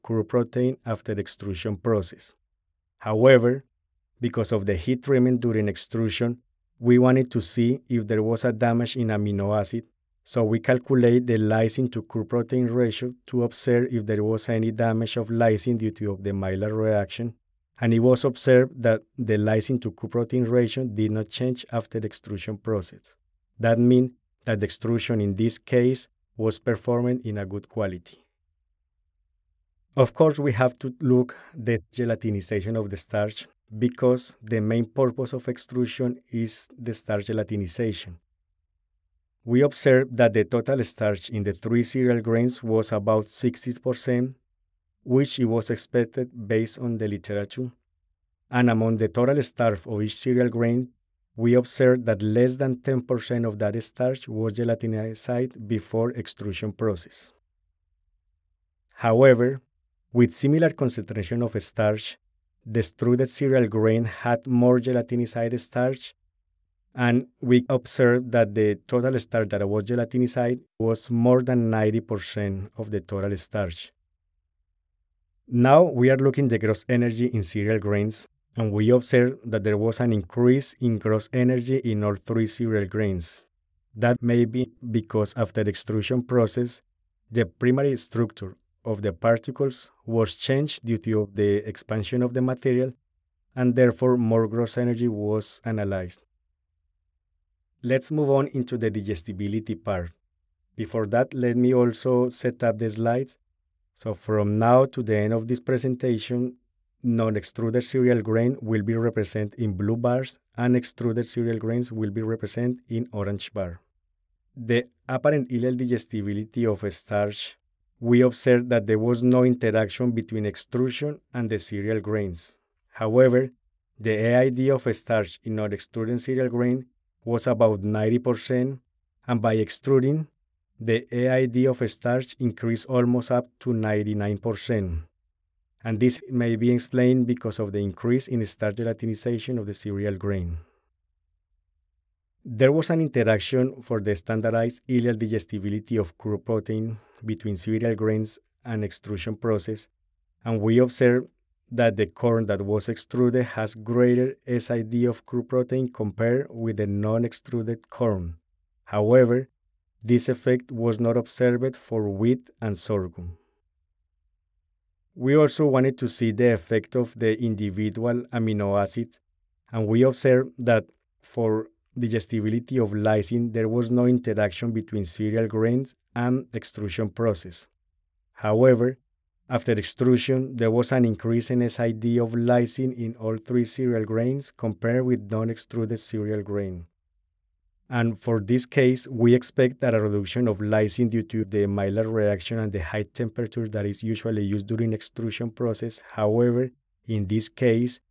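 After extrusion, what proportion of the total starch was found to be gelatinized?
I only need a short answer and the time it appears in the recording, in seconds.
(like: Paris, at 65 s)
more than 90%, at 71 s.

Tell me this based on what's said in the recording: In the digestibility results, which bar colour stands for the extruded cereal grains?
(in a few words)
orange.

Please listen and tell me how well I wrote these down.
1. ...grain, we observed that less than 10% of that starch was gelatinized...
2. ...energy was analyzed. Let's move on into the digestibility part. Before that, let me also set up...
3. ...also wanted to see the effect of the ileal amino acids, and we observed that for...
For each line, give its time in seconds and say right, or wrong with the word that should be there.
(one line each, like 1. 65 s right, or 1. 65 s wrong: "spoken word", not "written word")
1. 50 s right
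2. 94 s right
3. 165 s wrong: "individual", not "ileal".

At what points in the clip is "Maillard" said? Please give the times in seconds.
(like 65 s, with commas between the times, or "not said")
16 s, 191 s.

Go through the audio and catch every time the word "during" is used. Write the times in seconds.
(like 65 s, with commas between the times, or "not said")
5 s, 194 s.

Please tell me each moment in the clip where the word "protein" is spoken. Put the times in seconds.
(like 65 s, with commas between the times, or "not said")
0 s, 12 s, 20 s, 146 s, 155 s.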